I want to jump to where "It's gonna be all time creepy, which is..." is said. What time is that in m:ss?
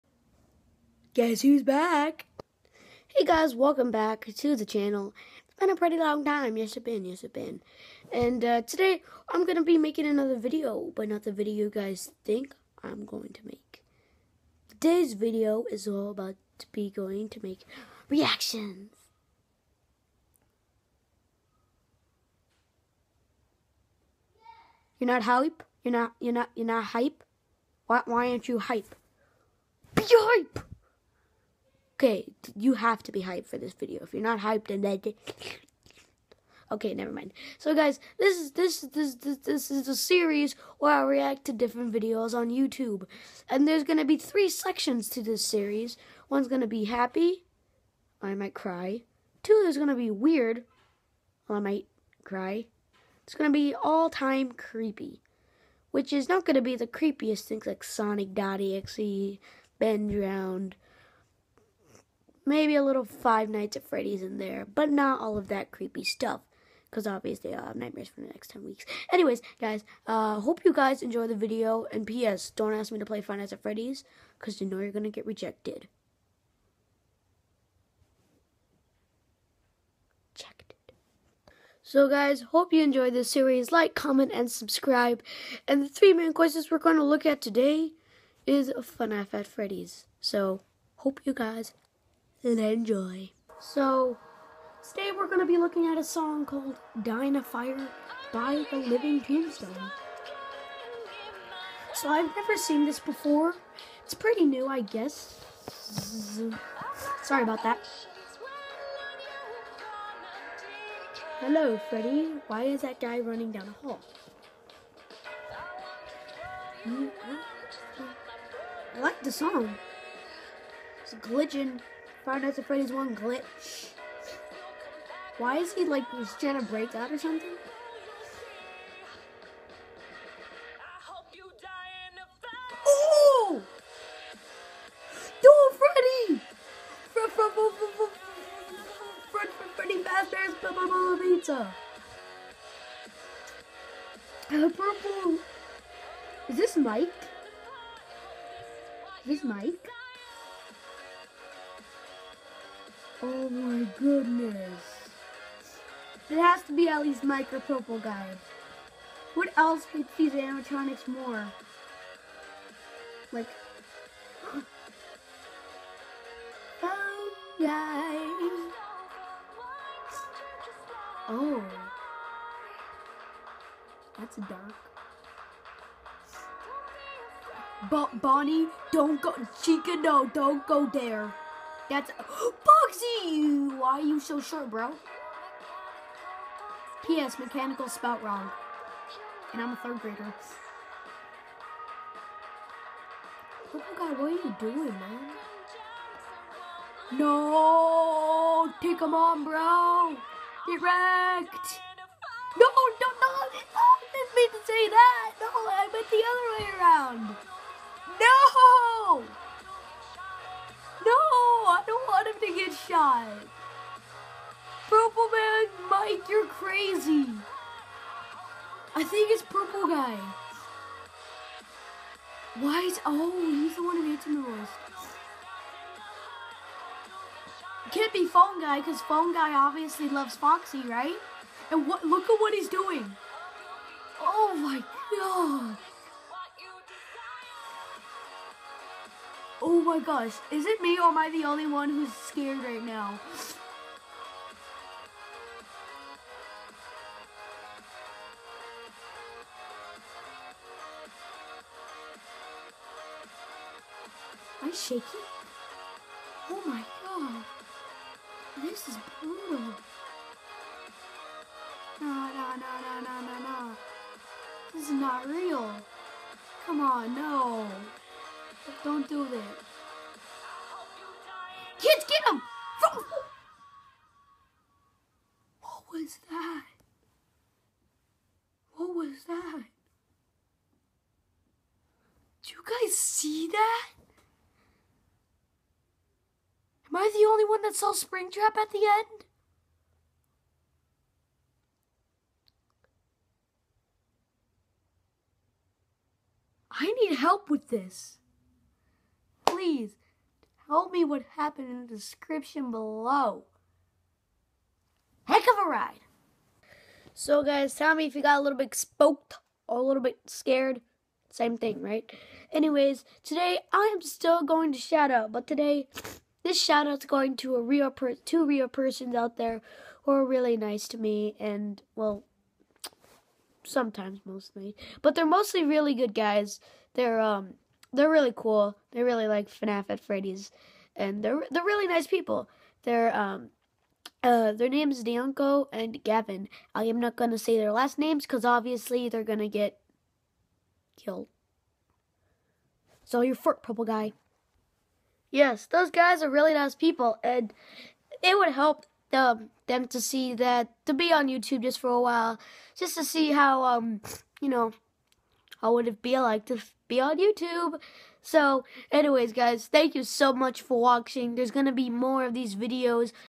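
0:53.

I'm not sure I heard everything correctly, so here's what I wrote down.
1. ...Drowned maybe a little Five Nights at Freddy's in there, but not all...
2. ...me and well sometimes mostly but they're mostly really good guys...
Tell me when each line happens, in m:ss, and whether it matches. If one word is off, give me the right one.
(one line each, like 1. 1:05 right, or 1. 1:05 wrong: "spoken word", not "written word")
1. 1:00 right
2. 5:20 right.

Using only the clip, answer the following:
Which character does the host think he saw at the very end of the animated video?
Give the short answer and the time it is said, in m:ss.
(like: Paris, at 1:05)
Springtrap, at 4:47.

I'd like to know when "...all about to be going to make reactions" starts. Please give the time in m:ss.
0:15.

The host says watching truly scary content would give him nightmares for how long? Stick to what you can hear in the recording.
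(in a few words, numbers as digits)
10 weeks.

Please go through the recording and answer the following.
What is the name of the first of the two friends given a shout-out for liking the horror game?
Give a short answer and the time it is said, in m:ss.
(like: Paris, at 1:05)
Deanko, at 5:35.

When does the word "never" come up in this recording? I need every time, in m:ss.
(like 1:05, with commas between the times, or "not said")
0:36, 1:42.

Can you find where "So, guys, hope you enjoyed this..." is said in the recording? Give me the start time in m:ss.
1:21.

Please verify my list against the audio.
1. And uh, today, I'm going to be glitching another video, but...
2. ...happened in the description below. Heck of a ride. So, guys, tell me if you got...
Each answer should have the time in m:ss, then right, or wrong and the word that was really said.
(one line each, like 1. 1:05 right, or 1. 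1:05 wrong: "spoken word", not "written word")
1. 0:08 wrong: "making", not "glitching"
2. 5:01 right.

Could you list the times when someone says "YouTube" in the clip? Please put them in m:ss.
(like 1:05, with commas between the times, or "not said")
0:42, 5:51, 5:57.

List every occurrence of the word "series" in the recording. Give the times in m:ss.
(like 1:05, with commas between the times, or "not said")
0:39, 0:45, 1:23.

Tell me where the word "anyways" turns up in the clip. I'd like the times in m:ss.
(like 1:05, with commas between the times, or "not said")
1:09, 5:12, 5:58.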